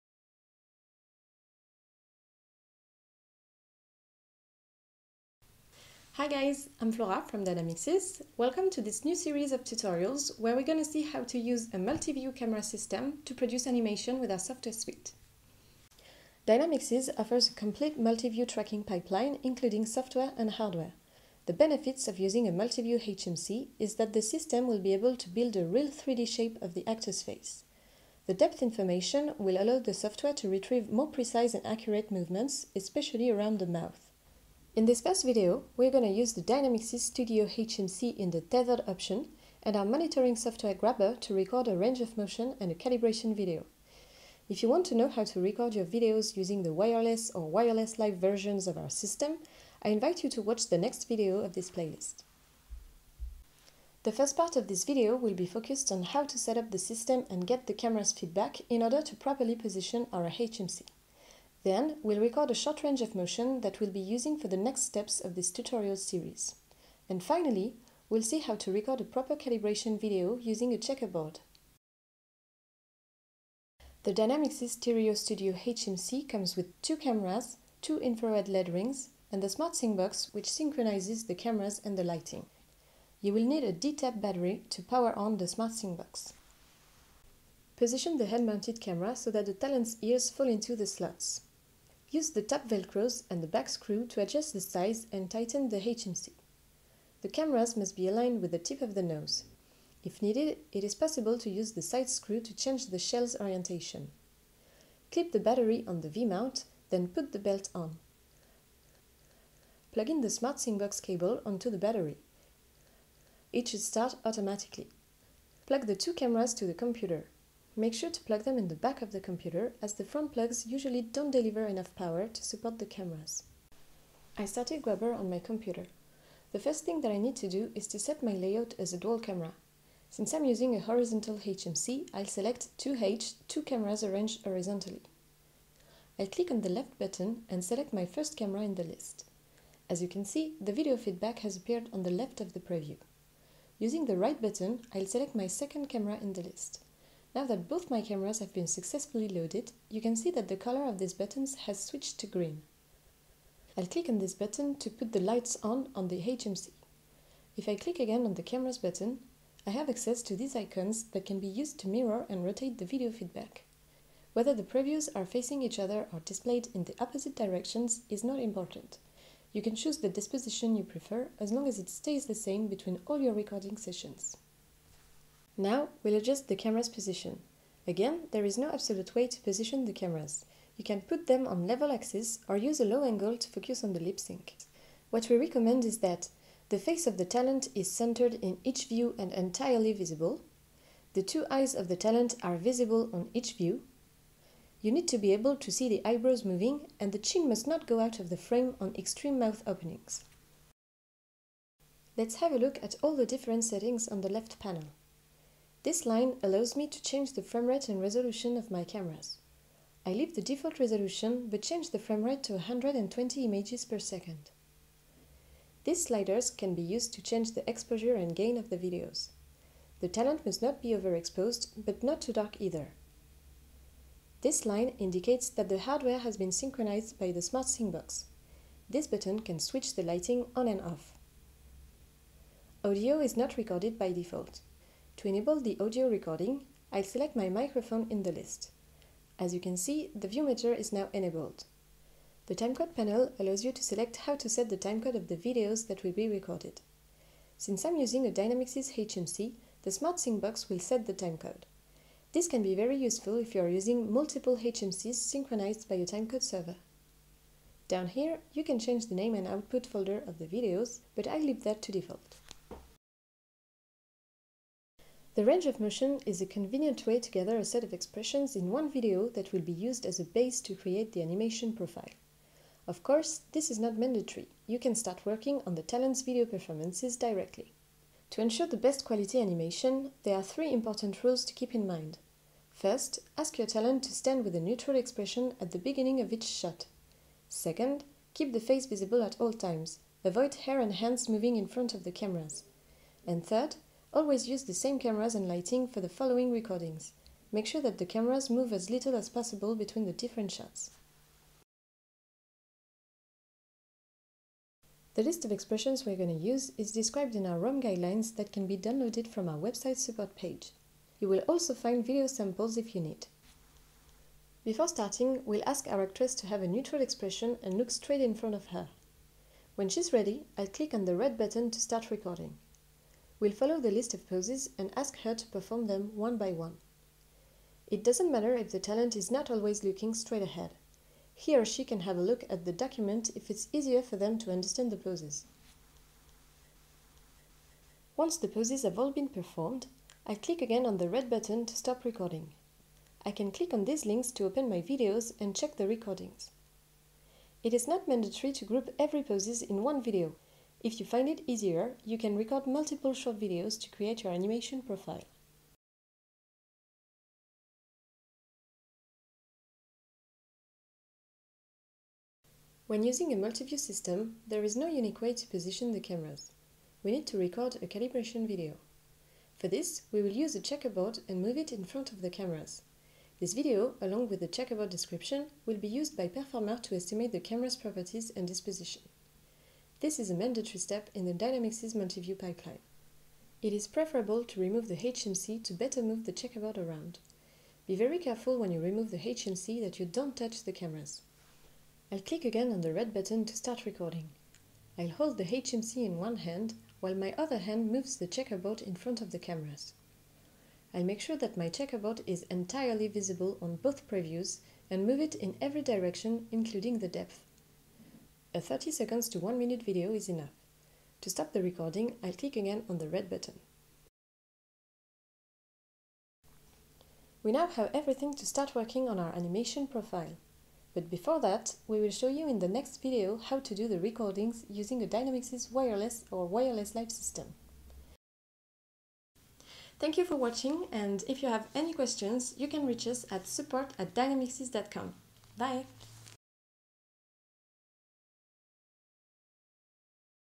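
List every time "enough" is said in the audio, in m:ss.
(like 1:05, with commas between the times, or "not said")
2:01, 6:50.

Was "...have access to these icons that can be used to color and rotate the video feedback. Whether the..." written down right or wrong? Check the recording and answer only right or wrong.
wrong.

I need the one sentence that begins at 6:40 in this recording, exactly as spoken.
I'll make sure that my checkerboard is entirely visible on both previews and move it in every direction including the depth.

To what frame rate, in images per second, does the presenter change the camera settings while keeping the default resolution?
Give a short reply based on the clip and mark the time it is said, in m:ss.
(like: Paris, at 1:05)
120, at 3:32.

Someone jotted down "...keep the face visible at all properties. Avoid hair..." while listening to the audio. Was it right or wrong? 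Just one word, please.
wrong.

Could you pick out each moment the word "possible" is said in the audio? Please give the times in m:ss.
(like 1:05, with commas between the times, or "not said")
1:40, 4:59.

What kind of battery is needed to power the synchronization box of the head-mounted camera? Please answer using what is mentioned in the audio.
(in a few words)
D-Tap battery.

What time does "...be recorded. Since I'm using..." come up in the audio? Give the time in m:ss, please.
4:06.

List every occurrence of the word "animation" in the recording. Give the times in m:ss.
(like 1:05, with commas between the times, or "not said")
0:13, 4:31, 4:39, 5:54, 6:59.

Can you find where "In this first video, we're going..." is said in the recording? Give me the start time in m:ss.
0:34.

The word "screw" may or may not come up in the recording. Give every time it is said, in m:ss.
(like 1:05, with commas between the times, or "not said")
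1:33, 1:42.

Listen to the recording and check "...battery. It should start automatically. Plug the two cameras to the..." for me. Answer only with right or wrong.
right.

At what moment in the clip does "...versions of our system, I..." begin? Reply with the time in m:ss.
0:48.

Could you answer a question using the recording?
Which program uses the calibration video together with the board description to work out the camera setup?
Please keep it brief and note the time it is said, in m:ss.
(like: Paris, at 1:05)
Performer, at 6:16.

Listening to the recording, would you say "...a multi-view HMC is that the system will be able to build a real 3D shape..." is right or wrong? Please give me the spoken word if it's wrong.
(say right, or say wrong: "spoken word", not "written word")
right.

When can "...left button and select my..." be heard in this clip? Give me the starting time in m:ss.
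2:16.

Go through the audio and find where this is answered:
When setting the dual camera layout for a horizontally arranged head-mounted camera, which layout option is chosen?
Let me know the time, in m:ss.
2:12.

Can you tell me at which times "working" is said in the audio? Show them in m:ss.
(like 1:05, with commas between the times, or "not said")
4:35, 6:58.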